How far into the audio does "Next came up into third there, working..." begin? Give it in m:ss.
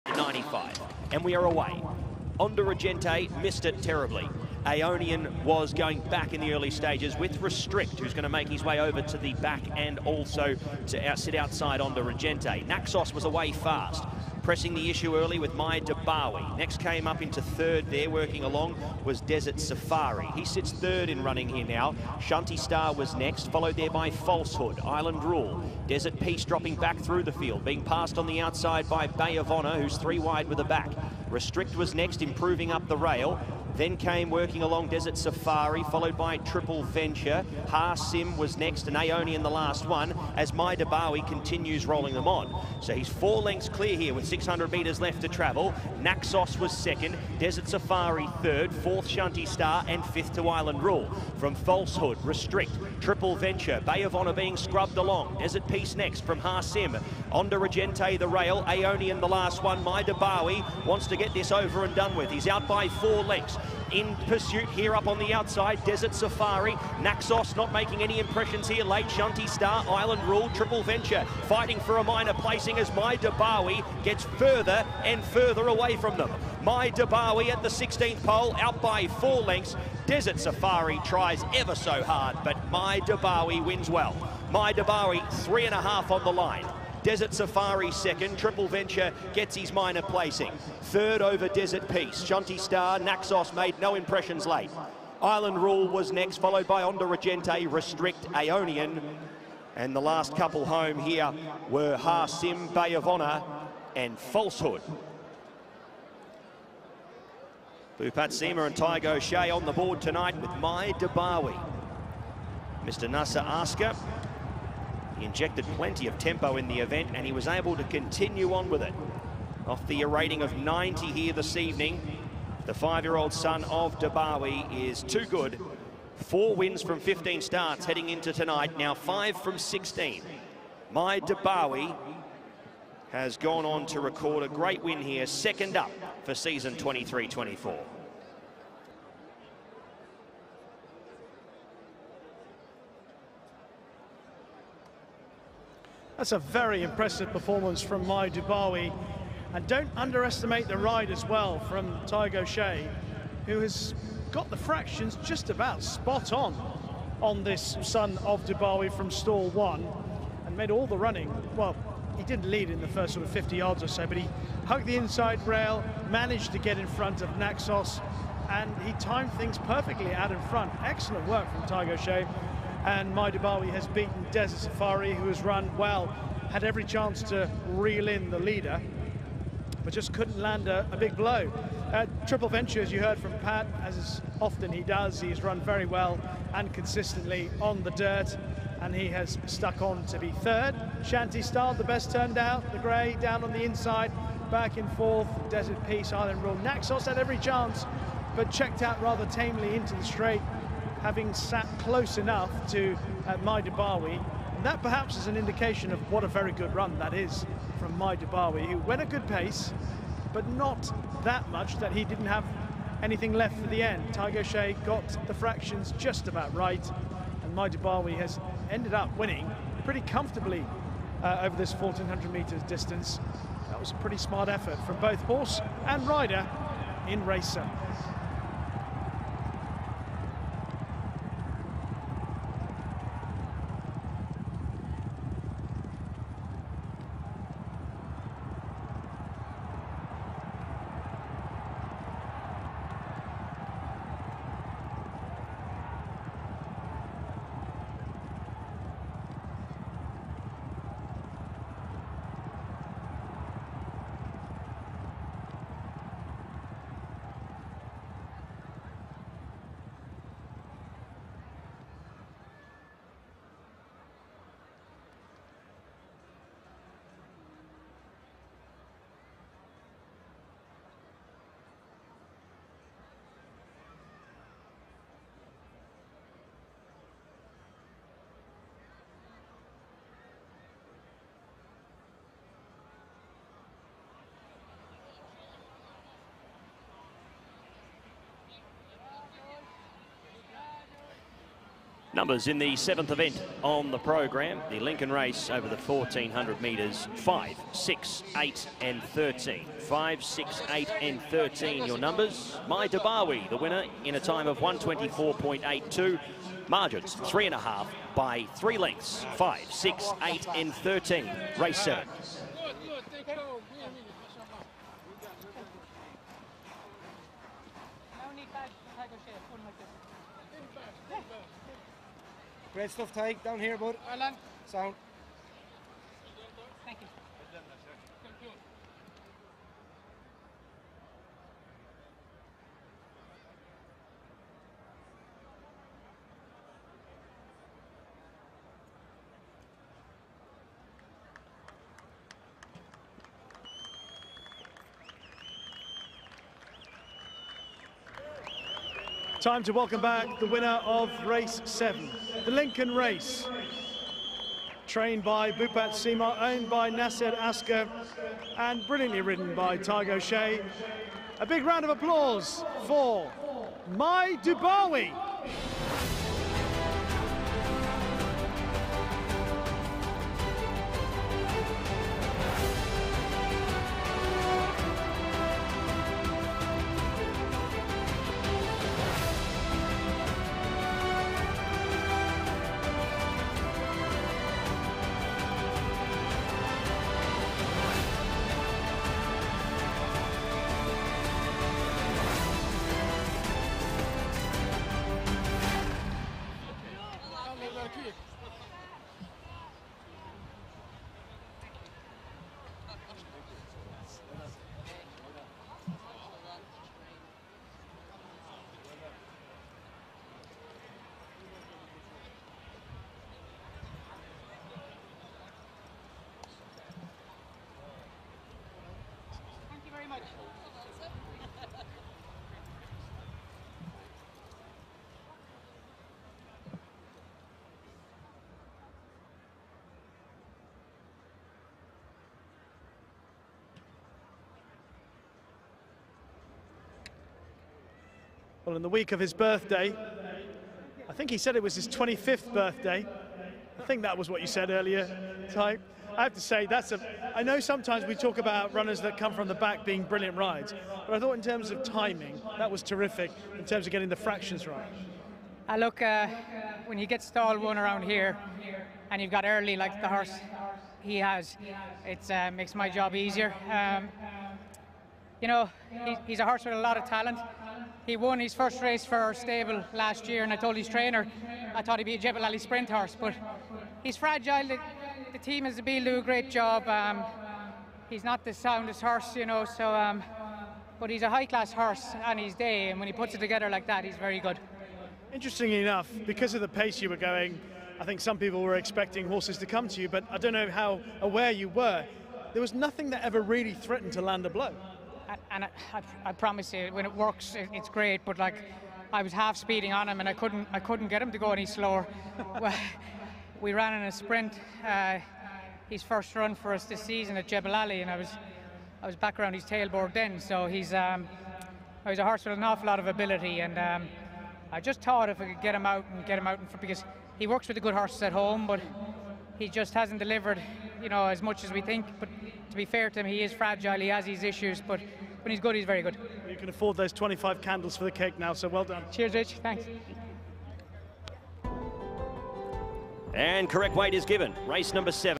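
0:16.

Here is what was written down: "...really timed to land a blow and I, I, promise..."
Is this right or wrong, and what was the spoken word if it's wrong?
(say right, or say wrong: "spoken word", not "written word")
wrong: "threatened", not "timed".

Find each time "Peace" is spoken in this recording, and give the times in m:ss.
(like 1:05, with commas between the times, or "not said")
0:26, 0:55, 1:31, 3:15.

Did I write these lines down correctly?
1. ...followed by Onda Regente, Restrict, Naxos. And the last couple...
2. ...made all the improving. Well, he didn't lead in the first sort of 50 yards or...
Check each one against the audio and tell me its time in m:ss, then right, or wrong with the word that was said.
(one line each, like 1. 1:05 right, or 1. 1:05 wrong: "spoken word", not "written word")
1. 1:36 wrong: "Aeonian", not "Naxos"
2. 2:40 wrong: "running", not "improving".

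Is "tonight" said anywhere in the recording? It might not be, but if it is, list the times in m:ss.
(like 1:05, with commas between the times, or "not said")
1:50, 2:08.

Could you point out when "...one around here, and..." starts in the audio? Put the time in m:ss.
7:37.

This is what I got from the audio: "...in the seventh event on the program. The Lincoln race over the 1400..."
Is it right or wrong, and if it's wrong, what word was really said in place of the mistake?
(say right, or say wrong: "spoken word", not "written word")
right.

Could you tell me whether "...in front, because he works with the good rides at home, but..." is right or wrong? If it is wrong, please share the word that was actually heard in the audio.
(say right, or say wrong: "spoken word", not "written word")
wrong: "horses", not "rides".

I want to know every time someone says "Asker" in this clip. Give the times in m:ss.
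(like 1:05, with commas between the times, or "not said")
1:53, 5:57.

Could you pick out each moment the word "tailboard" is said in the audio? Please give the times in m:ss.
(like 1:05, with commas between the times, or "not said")
8:29.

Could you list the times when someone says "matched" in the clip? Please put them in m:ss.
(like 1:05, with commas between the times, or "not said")
not said.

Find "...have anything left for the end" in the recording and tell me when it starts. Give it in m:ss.
3:32.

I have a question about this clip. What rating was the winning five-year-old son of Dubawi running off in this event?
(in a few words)
90.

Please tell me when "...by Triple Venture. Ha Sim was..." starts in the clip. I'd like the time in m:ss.
0:36.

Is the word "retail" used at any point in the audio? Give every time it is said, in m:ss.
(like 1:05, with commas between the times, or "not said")
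not said.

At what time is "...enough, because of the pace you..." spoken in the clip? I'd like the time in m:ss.
8:05.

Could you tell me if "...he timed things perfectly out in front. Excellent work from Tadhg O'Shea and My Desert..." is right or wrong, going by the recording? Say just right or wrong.
wrong.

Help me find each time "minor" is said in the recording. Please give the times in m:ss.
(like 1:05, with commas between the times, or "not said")
1:12, 1:29.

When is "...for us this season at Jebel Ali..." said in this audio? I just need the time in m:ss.
8:26.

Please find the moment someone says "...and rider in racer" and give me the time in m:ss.
3:45.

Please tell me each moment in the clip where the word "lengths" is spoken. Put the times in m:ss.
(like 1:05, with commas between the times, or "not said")
0:43, 1:03, 1:19, 5:08.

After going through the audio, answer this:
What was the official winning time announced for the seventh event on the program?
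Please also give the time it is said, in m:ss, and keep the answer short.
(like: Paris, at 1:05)
124.82, at 5:04.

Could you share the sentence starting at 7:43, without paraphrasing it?
Um, you know, he's a horse with a lot of talent.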